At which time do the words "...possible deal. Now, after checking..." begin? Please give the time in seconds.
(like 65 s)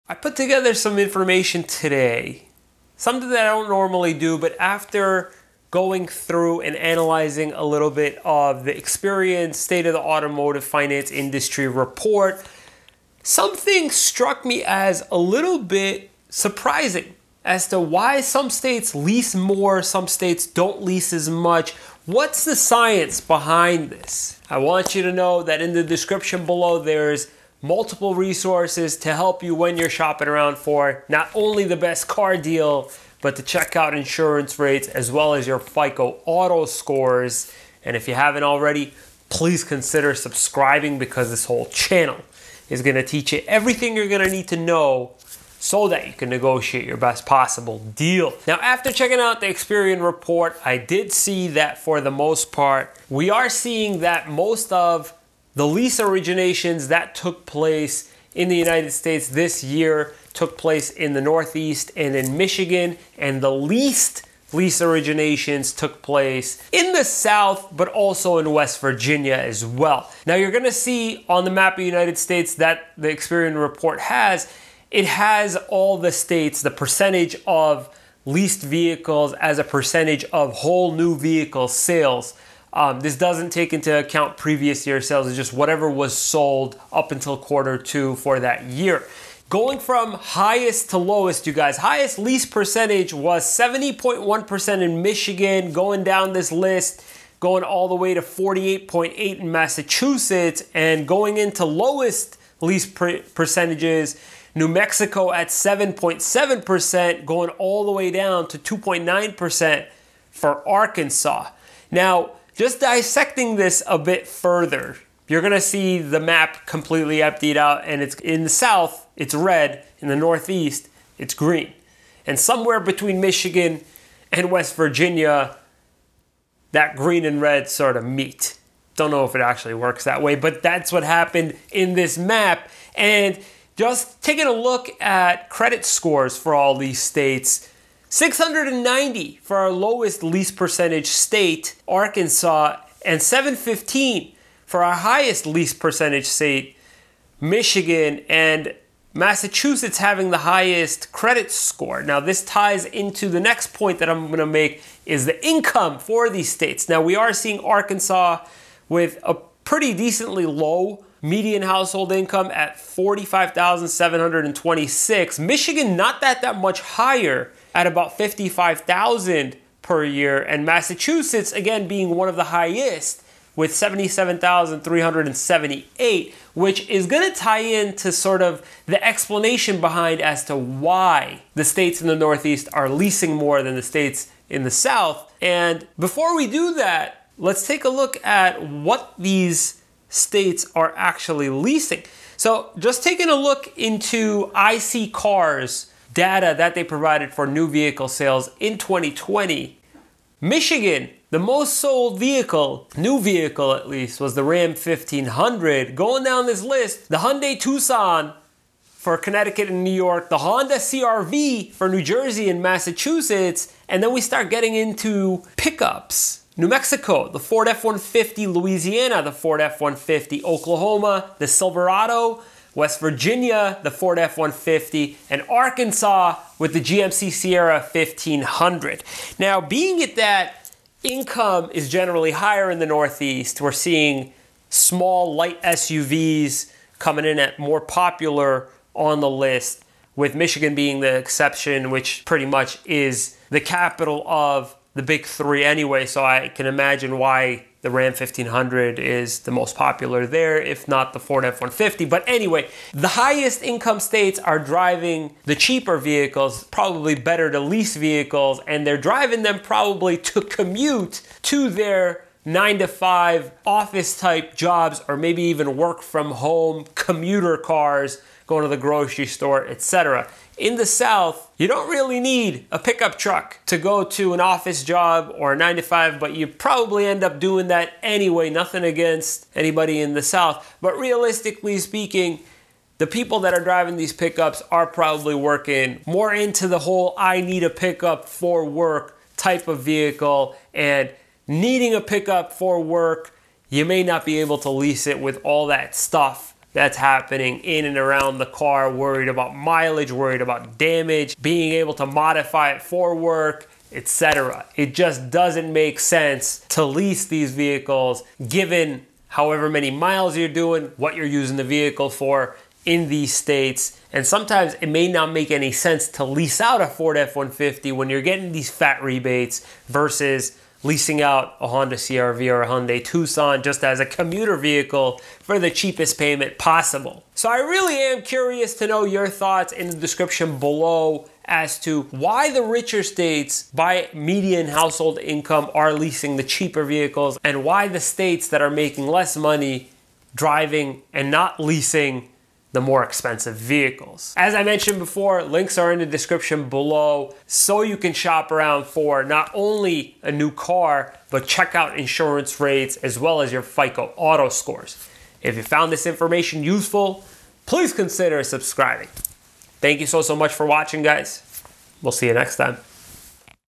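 47 s.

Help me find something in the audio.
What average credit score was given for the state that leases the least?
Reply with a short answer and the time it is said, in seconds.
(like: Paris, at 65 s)
690, at 138 s.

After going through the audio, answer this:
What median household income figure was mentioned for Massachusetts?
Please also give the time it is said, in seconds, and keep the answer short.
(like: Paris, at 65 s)
$77,378, at 173 s.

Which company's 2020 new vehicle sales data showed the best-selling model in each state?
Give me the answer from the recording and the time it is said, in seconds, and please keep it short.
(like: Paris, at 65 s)
iSeeCars, at 194 s.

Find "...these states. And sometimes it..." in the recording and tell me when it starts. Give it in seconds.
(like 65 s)
313 s.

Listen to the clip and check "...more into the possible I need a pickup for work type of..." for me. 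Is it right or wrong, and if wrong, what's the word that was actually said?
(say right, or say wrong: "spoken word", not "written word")
wrong: "whole", not "possible".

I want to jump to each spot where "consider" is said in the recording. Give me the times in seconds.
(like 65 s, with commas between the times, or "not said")
39 s, 357 s.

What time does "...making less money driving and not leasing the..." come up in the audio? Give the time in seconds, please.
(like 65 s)
338 s.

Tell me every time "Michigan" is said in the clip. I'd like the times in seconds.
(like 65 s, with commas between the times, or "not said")
62 s, 95 s, 123 s, 147 s, 165 s, 200 s, 240 s.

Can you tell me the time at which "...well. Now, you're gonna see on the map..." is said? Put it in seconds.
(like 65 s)
69 s.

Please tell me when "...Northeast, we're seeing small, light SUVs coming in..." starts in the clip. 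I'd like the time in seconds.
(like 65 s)
232 s.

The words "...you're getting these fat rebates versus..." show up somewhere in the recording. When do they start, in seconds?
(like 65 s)
318 s.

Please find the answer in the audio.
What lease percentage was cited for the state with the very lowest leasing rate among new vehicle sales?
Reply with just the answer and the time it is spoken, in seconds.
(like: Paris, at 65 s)
2.9%, at 108 s.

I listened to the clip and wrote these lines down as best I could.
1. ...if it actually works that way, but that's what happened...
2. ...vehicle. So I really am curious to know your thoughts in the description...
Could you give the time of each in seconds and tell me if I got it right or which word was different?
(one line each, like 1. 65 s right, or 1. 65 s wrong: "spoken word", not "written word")
1. 129 s right
2. 326 s wrong: "possible", not "vehicle".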